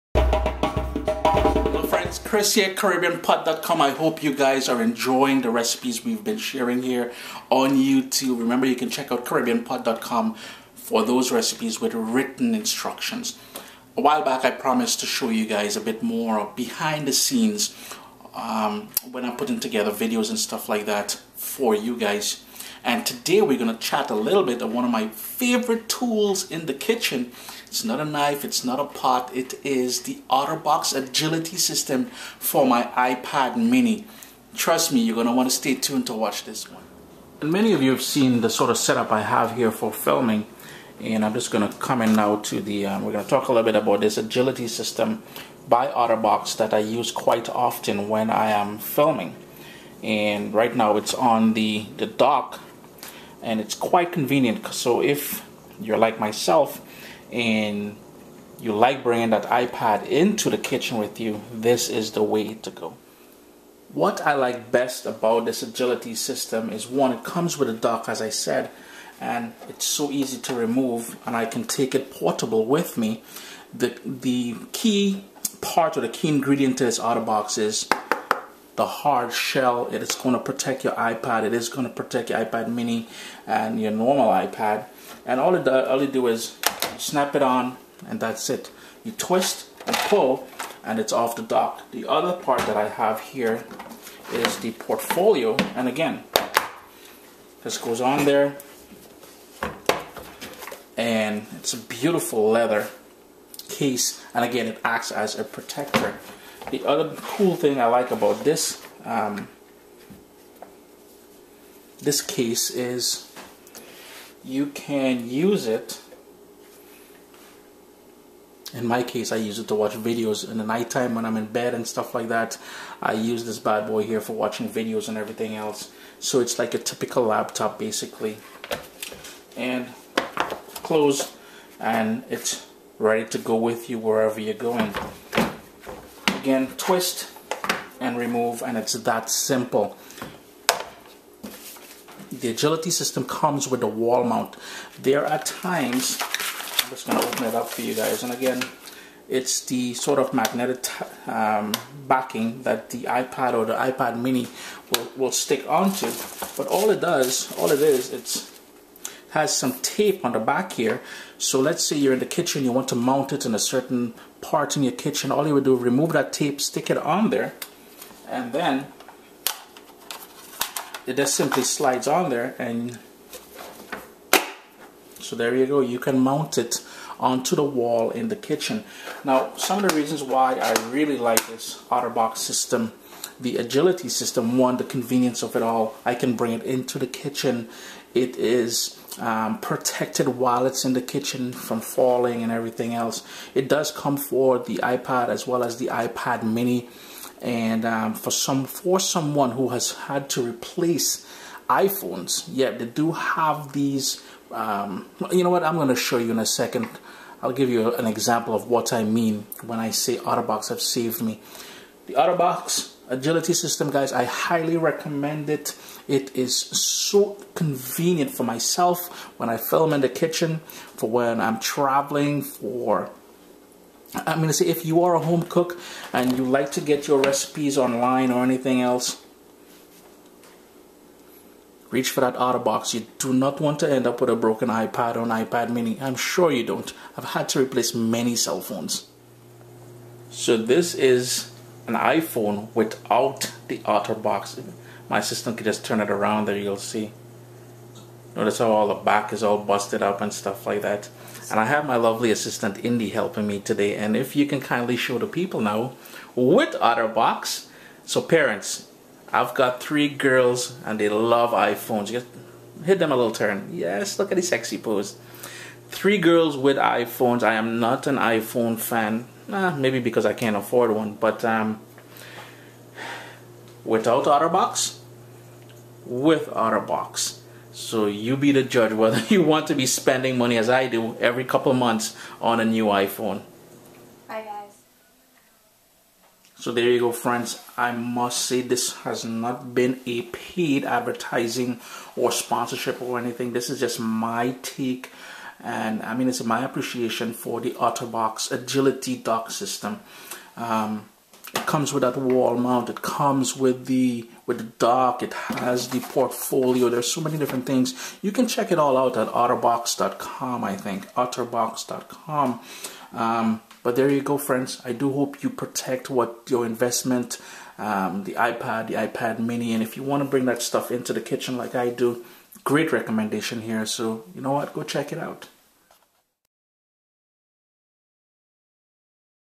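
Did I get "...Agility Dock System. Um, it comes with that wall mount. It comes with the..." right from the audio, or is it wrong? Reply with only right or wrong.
right.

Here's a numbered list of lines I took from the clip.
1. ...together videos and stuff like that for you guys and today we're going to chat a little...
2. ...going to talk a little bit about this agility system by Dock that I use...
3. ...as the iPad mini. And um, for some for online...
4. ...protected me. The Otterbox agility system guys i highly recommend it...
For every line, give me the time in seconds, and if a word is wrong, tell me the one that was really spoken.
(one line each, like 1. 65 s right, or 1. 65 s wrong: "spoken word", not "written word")
1. 19 s right
2. 43 s wrong: "OtterBox", not "Dock"
3. 195 s wrong: "someone", not "online"
4. 210 s wrong: "saved", not "protected".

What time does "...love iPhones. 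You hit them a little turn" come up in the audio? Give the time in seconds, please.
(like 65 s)
261 s.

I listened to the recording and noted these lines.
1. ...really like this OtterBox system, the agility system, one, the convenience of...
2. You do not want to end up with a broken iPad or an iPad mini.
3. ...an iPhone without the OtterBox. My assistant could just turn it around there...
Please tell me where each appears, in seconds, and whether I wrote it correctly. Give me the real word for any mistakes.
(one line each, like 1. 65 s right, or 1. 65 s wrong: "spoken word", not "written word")
1. 180 s right
2. 232 s right
3. 241 s right.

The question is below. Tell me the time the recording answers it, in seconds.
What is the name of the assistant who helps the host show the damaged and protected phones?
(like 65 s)
252 s.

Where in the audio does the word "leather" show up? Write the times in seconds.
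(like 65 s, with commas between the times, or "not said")
102 s.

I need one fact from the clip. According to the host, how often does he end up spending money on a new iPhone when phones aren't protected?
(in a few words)
Every couple months.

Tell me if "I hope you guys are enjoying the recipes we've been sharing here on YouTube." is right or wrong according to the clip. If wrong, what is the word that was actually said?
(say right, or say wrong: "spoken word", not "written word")
right.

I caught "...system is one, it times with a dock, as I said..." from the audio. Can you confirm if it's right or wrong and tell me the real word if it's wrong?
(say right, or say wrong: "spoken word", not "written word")
wrong: "comes", not "times".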